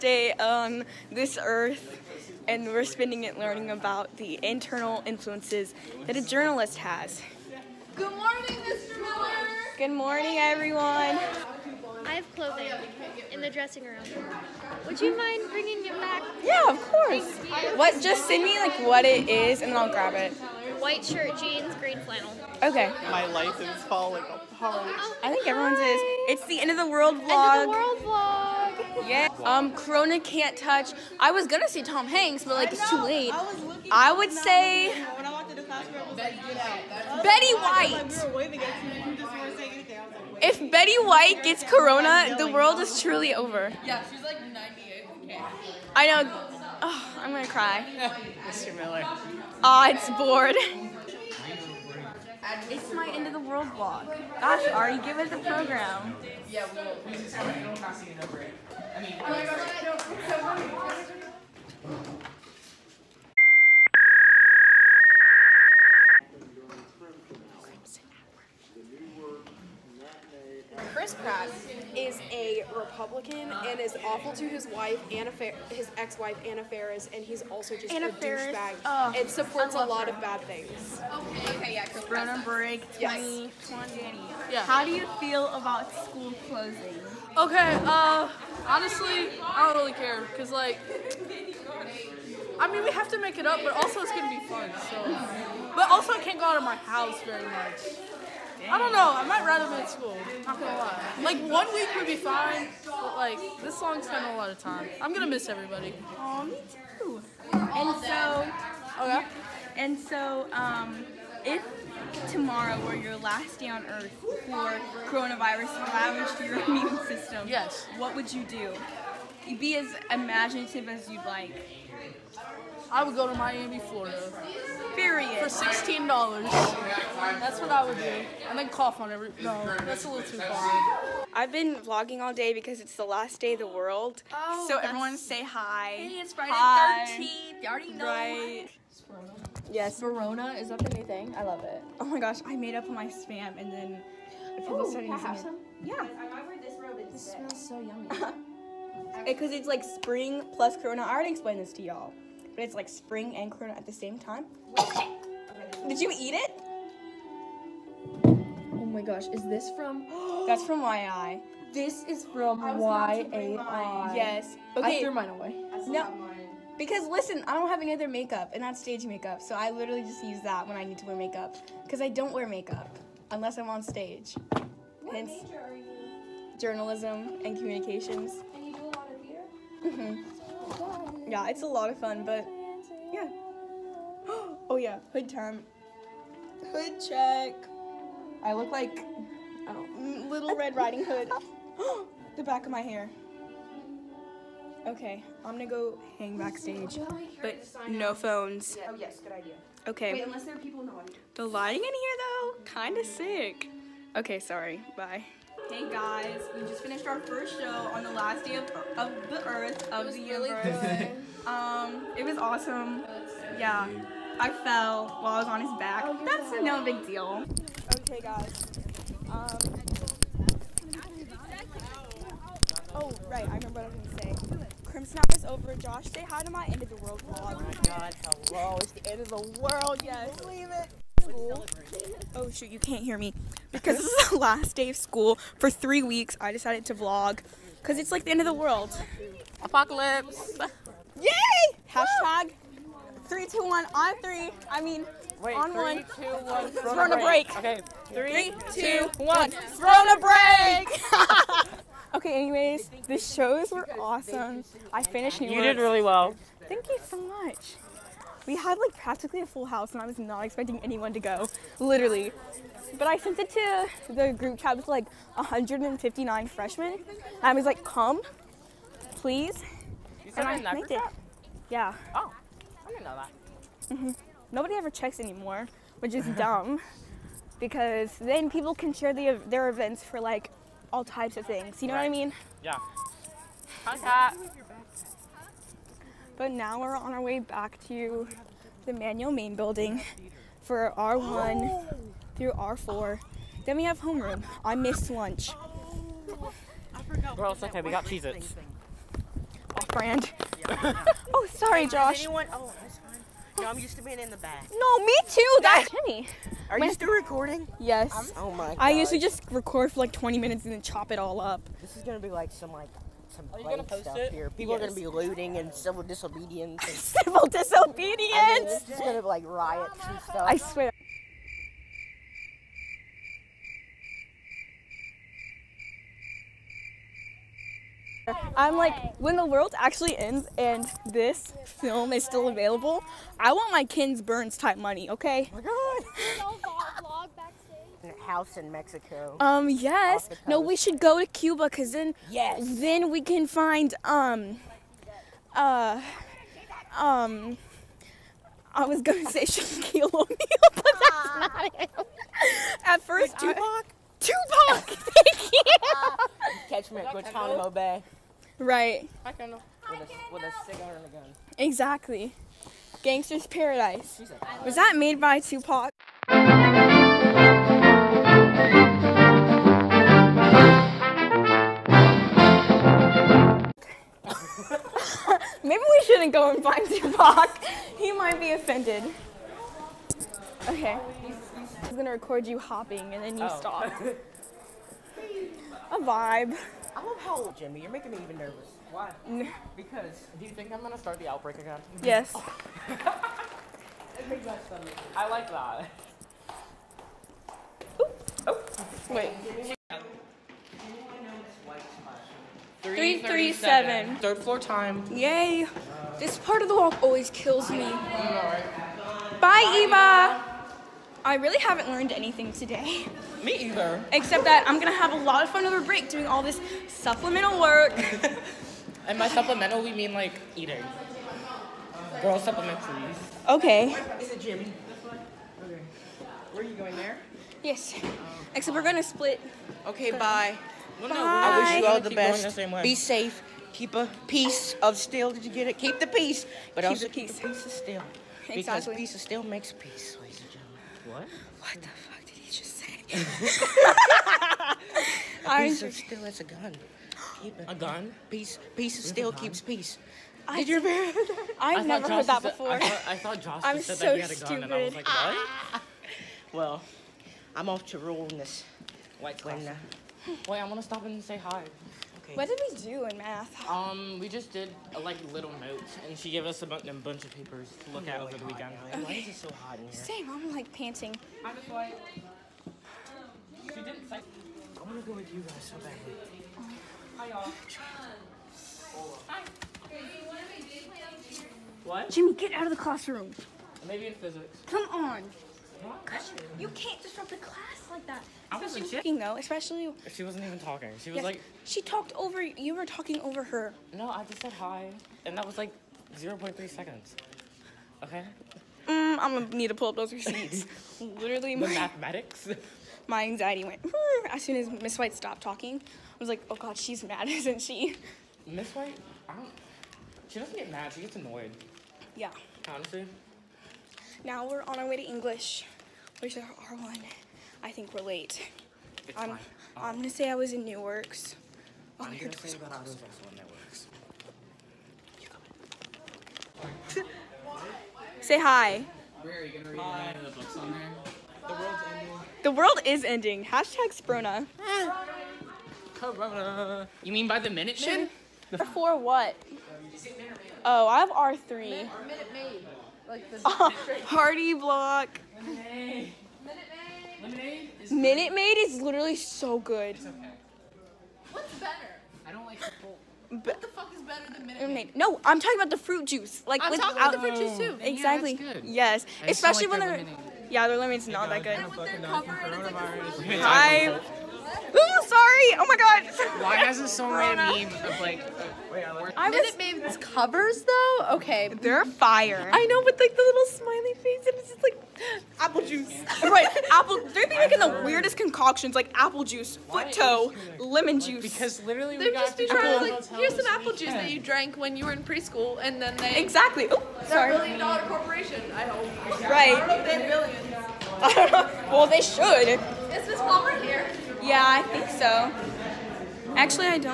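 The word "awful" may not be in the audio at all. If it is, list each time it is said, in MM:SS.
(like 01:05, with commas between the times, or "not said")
01:14.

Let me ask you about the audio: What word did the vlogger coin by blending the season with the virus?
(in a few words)
Sprona.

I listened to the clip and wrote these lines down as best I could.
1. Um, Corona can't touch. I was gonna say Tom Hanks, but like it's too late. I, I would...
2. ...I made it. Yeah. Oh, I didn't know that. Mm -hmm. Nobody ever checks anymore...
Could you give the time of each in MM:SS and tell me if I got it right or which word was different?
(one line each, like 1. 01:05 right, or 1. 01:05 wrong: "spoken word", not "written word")
1. 00:29 right
2. 04:30 right.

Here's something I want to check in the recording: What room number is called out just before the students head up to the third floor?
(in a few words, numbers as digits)
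337.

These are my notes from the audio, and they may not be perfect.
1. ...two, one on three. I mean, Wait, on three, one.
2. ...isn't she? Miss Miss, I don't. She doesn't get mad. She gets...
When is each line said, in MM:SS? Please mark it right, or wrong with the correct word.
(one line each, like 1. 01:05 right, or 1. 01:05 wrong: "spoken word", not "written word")
1. 04:03 right
2. 08:27 wrong: "White", not "Miss".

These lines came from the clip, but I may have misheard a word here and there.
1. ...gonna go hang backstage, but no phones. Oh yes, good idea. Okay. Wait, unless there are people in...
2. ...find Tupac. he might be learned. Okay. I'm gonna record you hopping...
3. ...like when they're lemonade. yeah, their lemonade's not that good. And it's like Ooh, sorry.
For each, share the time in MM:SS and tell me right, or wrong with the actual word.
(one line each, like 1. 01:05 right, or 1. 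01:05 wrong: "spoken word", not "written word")
1. 03:15 right
2. 06:16 wrong: "offended", not "learned"
3. 09:19 right.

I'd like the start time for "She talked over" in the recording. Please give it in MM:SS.
08:11.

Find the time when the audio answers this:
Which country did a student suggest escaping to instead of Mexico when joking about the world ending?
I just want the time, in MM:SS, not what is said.
05:41.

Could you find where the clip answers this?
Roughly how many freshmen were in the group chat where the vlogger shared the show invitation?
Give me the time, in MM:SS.
04:25.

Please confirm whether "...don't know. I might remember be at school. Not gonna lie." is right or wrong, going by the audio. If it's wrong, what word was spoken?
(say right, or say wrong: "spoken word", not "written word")
wrong: "rather", not "remember".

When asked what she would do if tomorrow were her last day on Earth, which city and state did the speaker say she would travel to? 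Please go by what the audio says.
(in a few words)
Miami, Florida.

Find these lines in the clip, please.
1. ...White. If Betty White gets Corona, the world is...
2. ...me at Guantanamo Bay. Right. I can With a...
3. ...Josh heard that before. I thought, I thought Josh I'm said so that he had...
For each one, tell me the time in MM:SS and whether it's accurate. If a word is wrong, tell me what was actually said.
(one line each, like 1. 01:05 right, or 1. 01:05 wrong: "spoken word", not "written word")
1. 00:37 right
2. 05:56 right
3. 07:32 right.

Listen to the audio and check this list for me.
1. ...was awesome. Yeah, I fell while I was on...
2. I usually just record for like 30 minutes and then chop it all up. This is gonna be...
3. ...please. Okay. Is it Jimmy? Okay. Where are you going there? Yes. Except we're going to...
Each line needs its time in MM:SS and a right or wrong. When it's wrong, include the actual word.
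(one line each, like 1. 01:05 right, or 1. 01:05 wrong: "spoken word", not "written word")
1. 03:32 right
2. 05:08 wrong: "20", not "30"
3. 07:02 right.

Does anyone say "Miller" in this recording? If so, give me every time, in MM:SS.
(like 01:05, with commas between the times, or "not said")
00:09, 00:48.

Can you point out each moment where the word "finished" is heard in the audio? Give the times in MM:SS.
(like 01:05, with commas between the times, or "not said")
03:26, 04:15.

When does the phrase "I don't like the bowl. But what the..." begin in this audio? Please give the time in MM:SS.
09:12.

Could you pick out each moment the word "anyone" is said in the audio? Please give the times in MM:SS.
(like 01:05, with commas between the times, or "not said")
04:20, 05:02.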